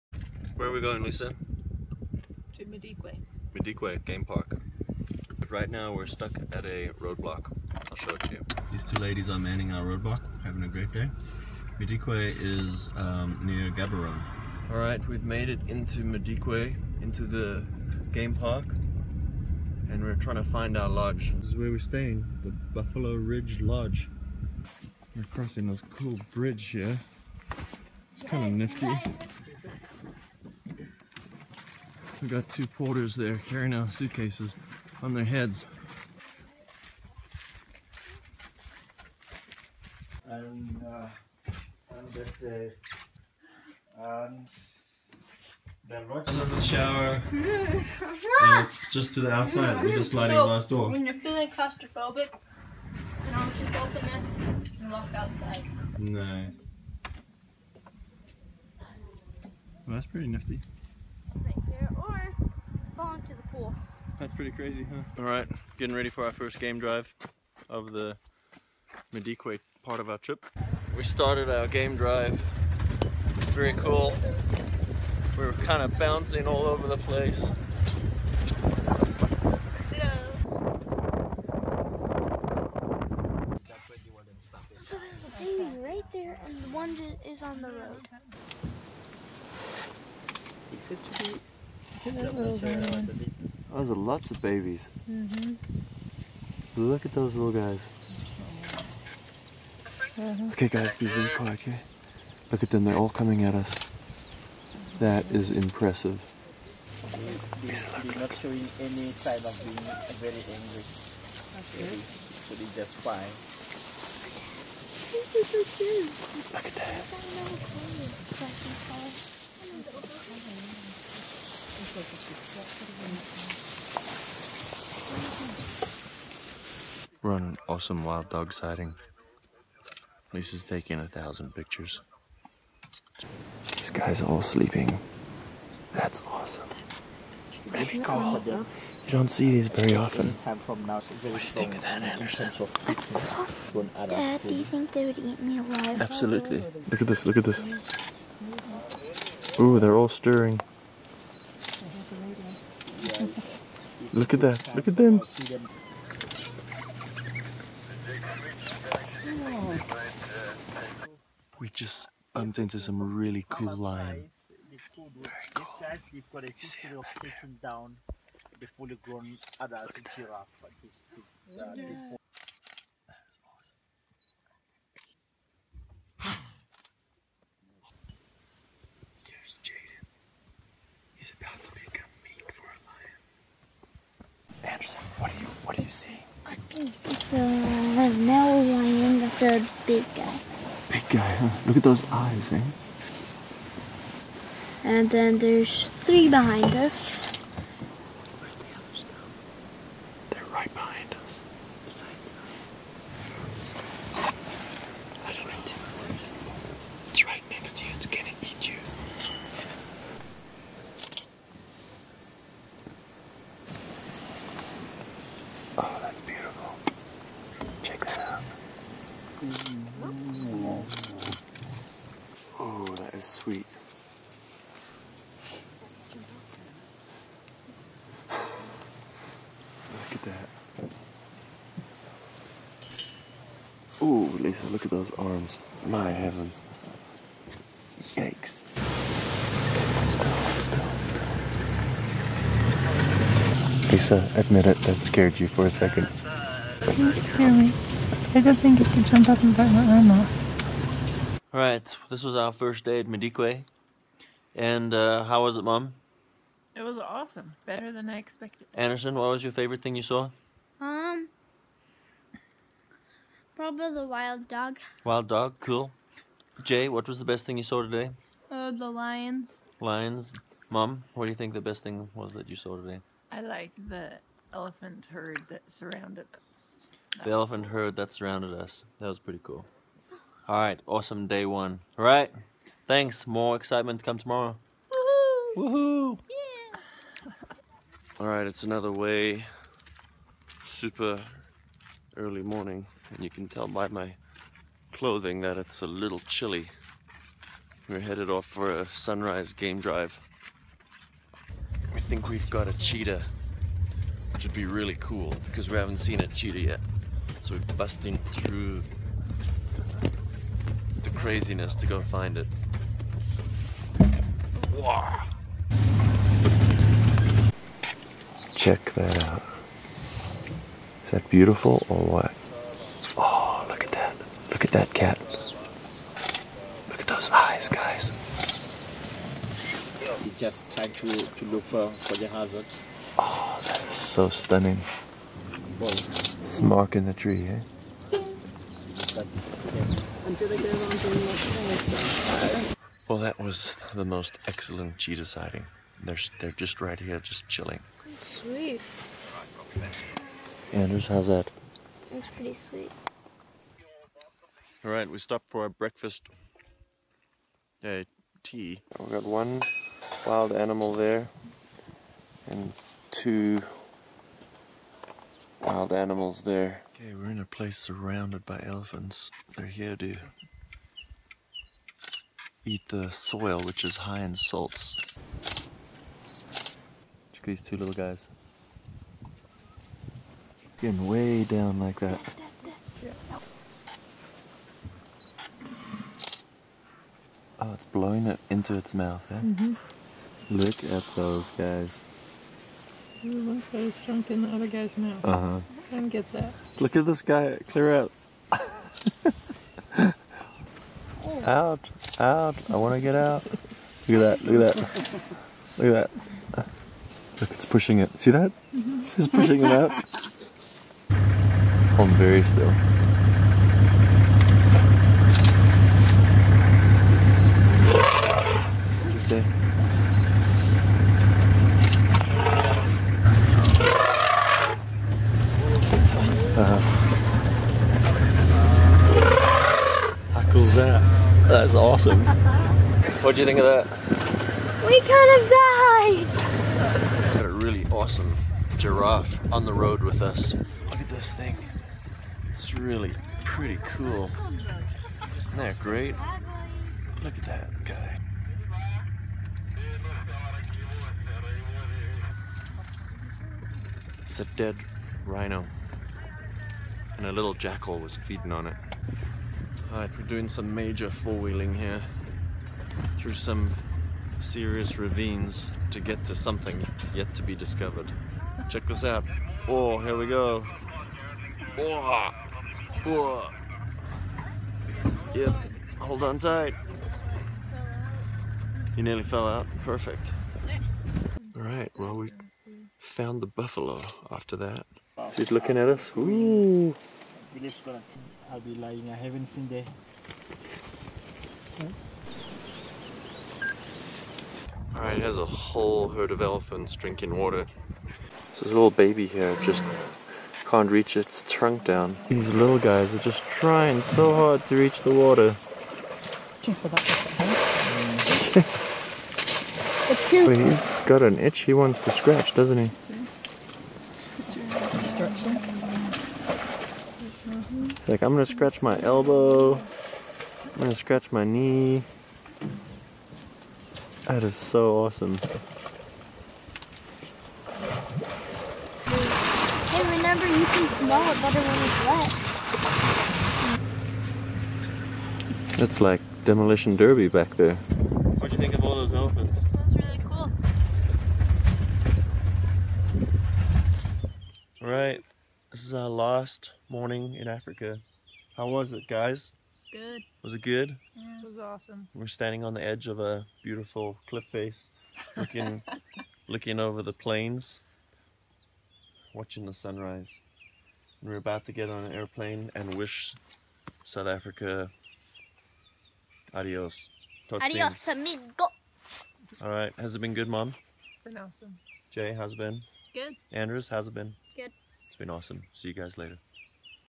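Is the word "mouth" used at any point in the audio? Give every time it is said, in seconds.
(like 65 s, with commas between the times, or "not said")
388 s, 394 s.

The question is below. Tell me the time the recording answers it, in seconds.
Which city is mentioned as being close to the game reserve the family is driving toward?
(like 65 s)
13 s.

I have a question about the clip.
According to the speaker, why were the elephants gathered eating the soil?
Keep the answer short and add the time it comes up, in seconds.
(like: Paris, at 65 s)
High in salts, at 373 s.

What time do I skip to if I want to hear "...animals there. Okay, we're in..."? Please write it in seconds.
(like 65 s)
365 s.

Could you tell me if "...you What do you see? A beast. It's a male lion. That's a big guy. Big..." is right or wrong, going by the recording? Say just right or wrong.
right.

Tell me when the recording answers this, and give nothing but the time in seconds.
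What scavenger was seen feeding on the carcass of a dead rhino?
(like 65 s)
457 s.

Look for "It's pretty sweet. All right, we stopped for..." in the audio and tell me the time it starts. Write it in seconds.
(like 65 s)
352 s.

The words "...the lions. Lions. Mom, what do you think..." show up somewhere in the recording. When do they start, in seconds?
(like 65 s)
268 s.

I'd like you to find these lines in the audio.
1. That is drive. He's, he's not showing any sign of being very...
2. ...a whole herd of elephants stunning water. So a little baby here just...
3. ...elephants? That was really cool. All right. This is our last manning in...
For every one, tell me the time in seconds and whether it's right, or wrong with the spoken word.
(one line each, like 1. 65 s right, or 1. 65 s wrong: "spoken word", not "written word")
1. 104 s wrong: "impressive", not "drive"
2. 495 s wrong: "drinking", not "stunning"
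3. 539 s wrong: "morning", not "manning".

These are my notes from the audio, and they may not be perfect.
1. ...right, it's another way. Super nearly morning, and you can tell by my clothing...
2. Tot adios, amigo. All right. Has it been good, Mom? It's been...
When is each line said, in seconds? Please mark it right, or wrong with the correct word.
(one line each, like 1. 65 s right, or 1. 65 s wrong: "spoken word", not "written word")
1. 288 s wrong: "early", not "nearly"
2. 567 s right.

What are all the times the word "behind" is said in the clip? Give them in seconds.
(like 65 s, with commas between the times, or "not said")
196 s, 200 s.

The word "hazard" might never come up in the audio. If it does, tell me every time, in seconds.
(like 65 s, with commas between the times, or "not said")
332 s.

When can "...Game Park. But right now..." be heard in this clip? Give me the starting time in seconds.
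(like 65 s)
4 s.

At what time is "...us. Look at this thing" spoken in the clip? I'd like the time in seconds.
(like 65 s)
440 s.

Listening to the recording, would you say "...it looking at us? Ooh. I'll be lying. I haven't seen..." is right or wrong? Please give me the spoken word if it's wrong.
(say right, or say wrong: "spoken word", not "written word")
right.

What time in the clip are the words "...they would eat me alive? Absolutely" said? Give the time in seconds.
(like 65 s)
144 s.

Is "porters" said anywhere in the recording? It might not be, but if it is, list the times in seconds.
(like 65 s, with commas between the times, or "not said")
32 s.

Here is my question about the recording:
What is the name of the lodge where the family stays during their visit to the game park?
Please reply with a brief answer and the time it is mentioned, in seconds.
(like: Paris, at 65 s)
Buffalo Ridge Lodge, at 22 s.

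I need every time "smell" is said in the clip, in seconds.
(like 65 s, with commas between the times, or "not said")
530 s.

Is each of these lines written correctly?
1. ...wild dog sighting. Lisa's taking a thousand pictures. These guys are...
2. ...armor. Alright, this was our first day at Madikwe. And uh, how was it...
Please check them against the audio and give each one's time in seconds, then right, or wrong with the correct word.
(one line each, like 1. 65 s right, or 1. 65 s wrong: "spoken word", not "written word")
1. 128 s right
2. 249 s right.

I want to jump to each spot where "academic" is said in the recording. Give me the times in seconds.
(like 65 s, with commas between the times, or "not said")
not said.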